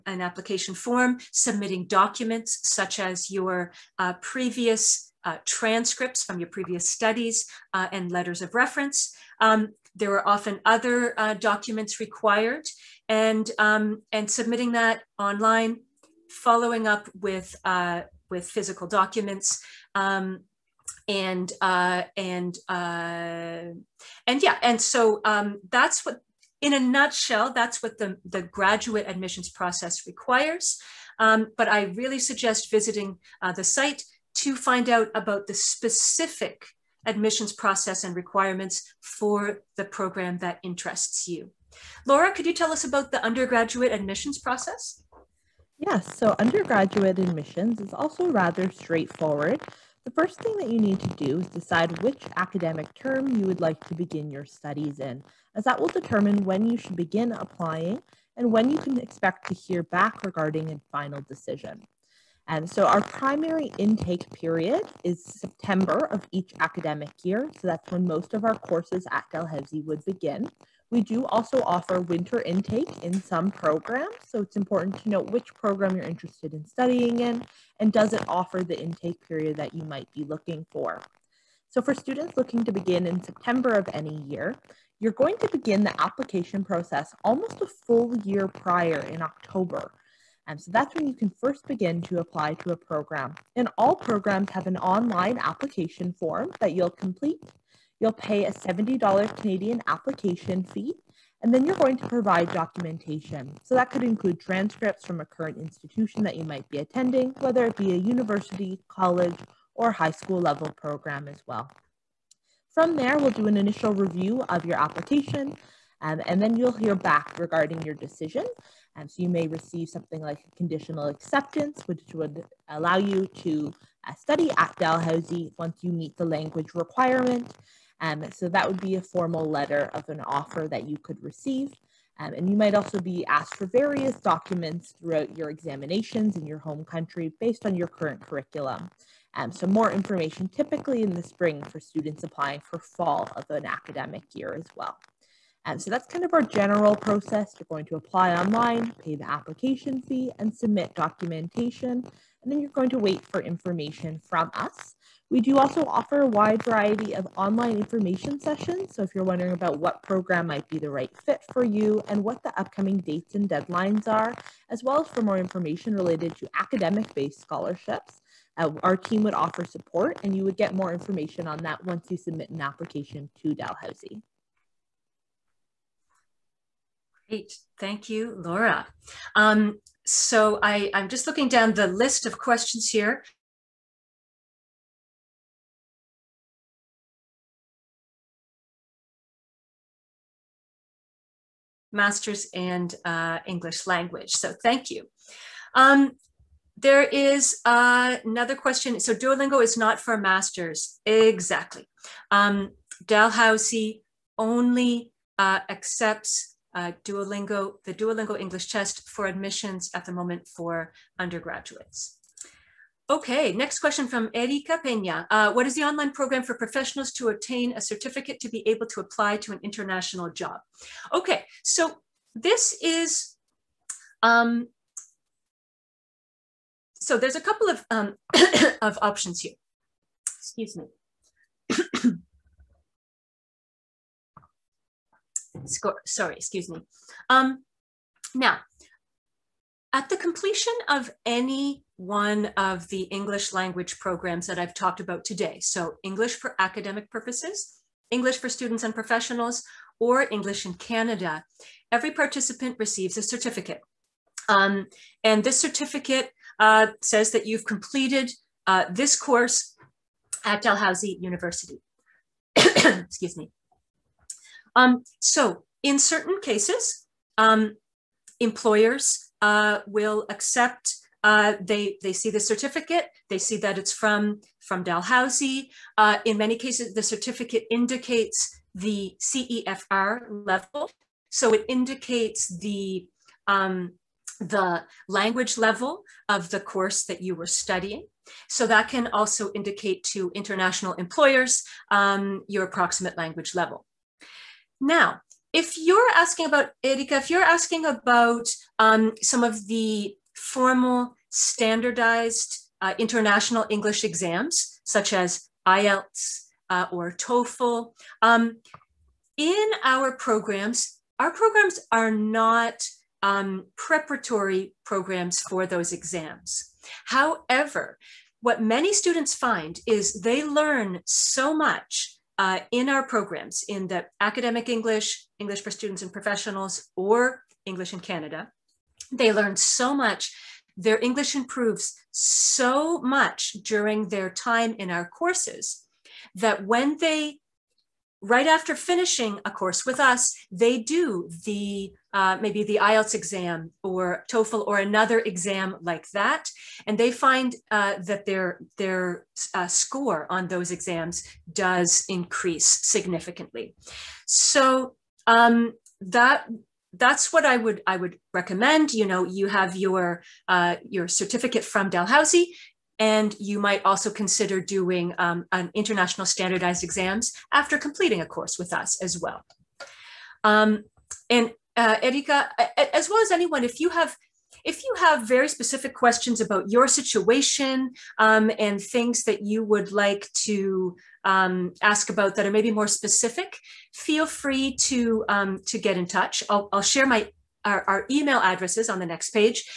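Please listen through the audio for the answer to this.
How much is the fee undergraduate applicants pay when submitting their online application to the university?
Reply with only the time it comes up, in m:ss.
1:38.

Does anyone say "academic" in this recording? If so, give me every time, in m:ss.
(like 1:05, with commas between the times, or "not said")
0:52, 1:06, 2:23, 2:46, 4:06, 5:24.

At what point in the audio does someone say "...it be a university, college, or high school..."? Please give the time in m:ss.
1:47.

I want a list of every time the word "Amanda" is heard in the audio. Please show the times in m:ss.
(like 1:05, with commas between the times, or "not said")
not said.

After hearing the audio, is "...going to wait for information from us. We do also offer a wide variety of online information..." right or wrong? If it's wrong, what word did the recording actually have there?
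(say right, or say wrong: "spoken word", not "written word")
right.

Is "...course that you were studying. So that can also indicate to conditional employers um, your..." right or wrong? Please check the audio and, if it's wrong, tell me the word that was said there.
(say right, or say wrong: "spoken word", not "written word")
wrong: "international", not "conditional".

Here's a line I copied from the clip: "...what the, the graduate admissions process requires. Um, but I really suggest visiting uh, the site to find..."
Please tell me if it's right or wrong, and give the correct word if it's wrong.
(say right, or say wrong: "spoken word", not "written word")
right.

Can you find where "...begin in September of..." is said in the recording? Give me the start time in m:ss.
1:22.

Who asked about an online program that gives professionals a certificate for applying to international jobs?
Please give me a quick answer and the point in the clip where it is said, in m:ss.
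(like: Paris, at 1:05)
Erika Peña, at 3:34.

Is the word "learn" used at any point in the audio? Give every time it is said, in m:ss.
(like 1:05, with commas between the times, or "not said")
5:20, 5:29.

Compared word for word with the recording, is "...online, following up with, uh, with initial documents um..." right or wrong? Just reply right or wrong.
wrong.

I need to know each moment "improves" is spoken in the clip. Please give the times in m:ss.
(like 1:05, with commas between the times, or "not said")
5:31.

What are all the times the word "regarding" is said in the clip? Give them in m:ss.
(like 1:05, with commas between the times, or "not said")
1:00, 1:57.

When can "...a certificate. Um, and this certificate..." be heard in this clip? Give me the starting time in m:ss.
4:13.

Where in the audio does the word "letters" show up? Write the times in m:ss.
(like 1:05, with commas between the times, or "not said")
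0:08, 2:09.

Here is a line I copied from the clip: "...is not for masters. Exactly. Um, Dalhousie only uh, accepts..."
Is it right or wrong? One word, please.
right.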